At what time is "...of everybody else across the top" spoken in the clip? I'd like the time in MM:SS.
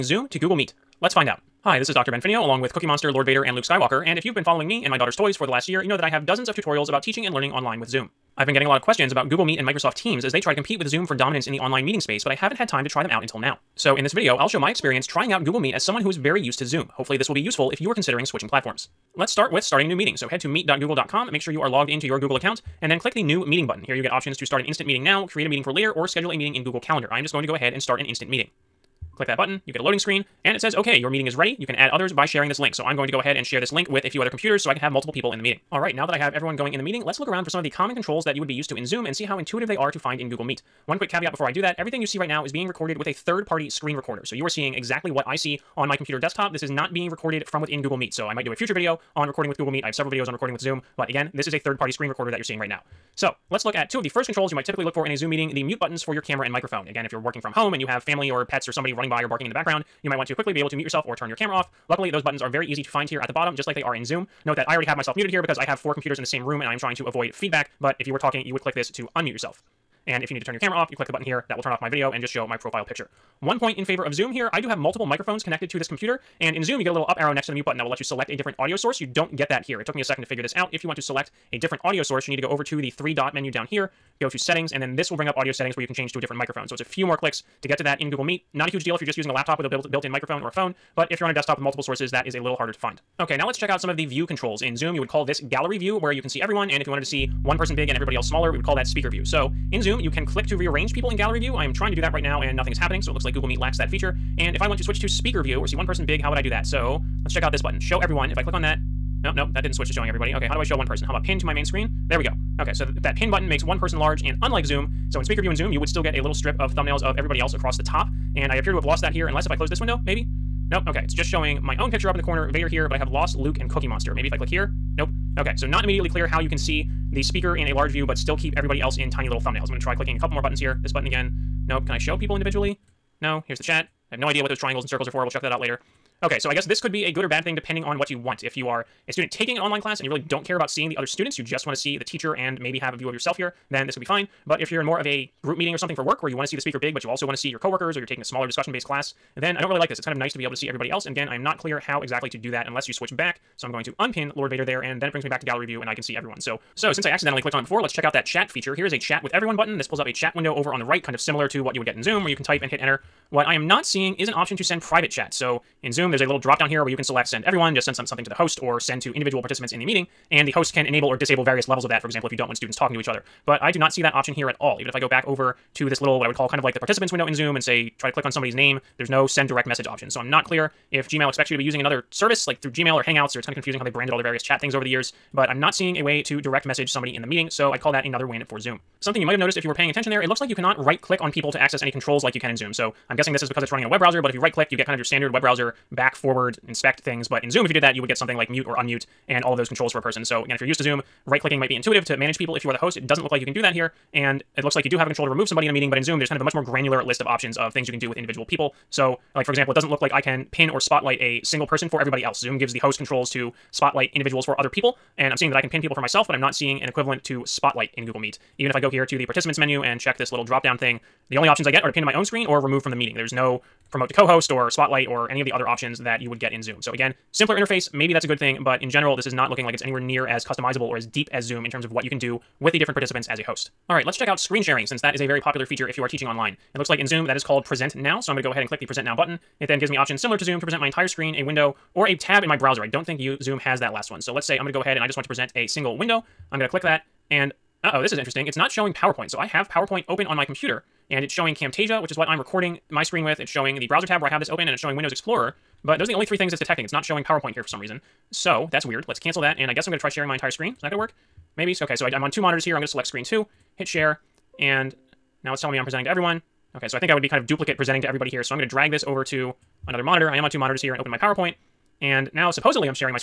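01:57.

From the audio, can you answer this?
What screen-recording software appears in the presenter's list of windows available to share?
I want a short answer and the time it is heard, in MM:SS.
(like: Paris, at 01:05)
Camtasia, at 04:11.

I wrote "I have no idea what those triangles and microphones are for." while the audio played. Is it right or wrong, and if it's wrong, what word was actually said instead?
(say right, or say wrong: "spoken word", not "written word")
wrong: "circles", not "microphones".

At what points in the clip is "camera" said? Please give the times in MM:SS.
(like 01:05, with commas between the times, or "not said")
00:56, 01:01, 01:10.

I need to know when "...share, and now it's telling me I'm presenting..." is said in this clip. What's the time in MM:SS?
04:23.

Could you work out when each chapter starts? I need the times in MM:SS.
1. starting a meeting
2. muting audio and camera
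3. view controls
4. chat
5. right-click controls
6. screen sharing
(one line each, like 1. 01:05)
1. 00:18
2. 00:35
3. 01:32
4. 02:36
5. 03:08
6. 03:53.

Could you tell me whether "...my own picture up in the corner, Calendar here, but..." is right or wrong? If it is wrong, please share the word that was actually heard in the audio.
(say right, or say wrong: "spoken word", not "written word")
wrong: "Vader", not "Calendar".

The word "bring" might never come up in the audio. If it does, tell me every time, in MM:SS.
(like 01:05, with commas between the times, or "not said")
01:25, 02:35.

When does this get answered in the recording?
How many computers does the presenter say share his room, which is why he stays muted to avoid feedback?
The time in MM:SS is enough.
01:05.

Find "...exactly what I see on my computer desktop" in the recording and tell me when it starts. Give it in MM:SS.
00:44.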